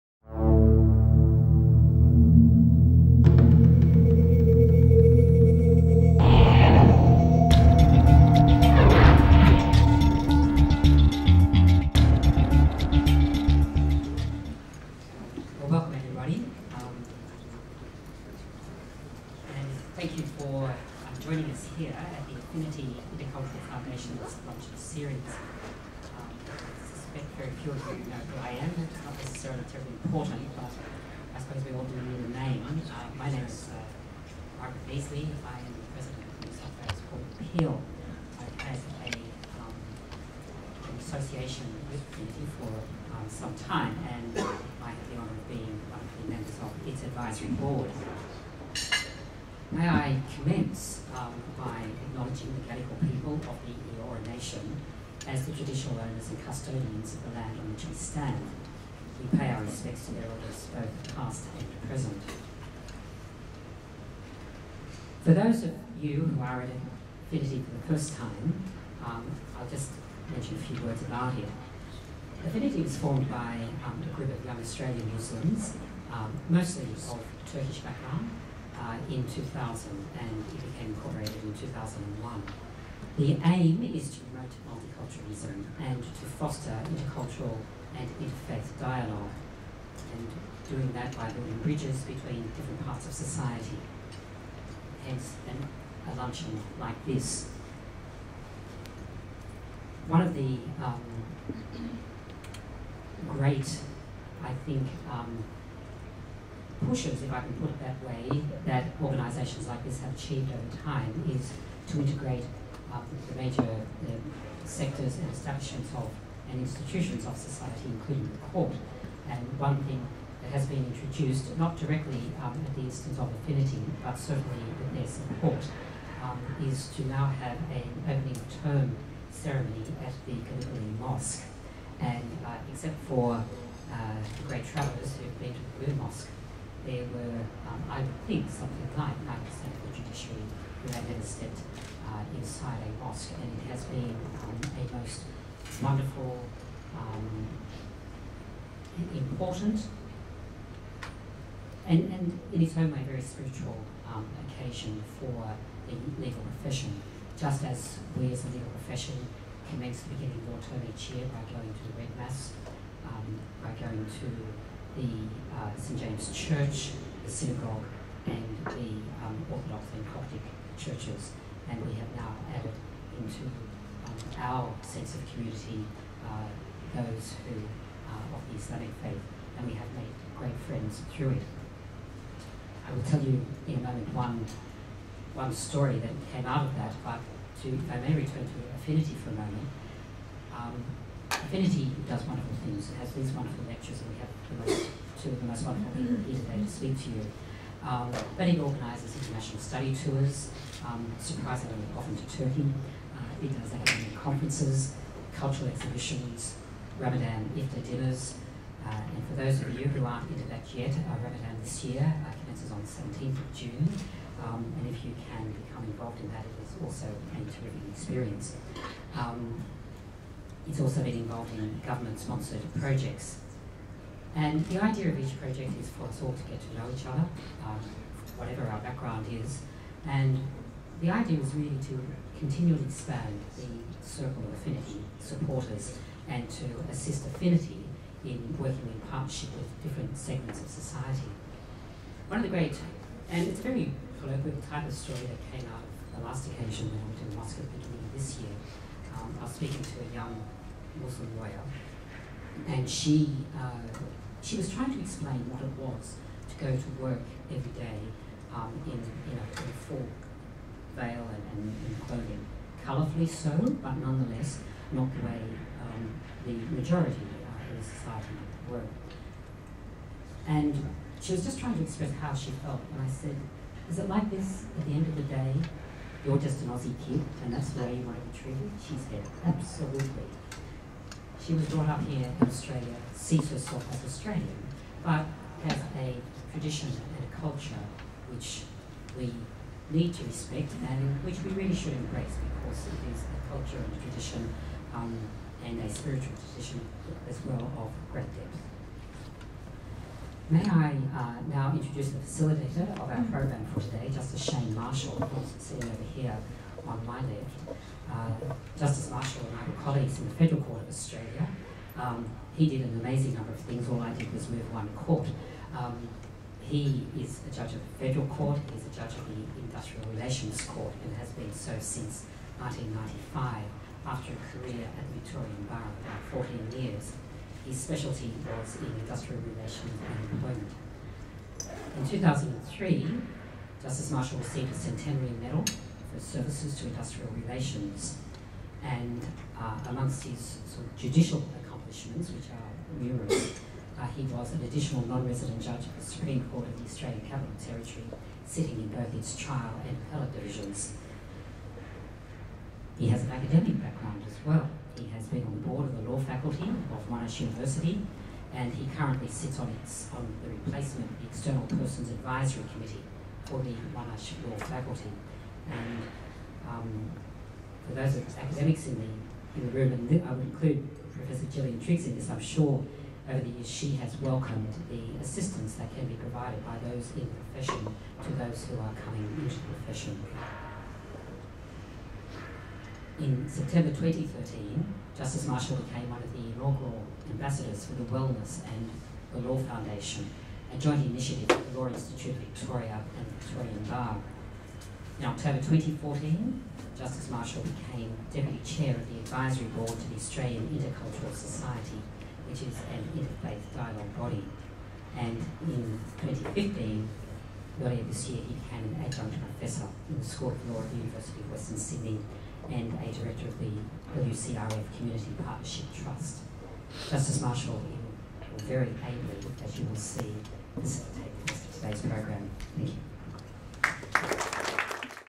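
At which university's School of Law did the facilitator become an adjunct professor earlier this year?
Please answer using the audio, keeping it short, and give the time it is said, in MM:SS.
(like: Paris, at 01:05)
University of Western Sydney, at 06:50.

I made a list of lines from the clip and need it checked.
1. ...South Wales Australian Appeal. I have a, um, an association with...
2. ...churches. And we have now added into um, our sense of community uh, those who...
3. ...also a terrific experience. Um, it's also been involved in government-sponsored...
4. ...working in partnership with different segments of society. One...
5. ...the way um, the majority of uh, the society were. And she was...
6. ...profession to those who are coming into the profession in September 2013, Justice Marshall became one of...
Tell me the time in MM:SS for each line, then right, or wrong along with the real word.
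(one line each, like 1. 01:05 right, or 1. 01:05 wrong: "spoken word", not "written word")
1. 00:36 wrong: "Court", not "Australian"
2. 02:50 right
3. 03:36 right
4. 03:58 right
5. 04:25 right
6. 06:17 right.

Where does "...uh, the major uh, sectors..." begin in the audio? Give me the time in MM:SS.
01:52.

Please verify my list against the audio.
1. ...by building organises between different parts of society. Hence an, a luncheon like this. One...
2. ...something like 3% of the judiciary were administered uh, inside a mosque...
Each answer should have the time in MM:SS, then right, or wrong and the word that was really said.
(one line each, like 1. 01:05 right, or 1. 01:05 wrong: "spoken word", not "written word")
1. 01:31 wrong: "bridges", not "organises"
2. 02:18 wrong: "9", not "3".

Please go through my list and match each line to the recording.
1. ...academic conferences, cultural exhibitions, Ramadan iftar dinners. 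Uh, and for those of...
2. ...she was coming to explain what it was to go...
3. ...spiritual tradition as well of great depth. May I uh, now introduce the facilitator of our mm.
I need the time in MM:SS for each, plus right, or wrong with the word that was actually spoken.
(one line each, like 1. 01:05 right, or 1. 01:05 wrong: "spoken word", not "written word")
1. 03:23 right
2. 04:14 wrong: "trying", not "coming"
3. 04:55 right.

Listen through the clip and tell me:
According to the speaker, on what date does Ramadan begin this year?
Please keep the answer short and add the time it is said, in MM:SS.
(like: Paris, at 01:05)
17th of June, at 03:32.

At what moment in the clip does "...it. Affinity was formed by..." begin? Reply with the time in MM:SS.
01:11.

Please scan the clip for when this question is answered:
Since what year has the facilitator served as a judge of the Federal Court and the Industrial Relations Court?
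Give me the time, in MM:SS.
05:22.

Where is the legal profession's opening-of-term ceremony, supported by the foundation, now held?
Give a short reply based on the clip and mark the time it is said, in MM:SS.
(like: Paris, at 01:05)
Gallipoli Mosque, at 02:10.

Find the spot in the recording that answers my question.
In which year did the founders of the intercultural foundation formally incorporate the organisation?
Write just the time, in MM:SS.
01:21.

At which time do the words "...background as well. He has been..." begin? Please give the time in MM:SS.
05:53.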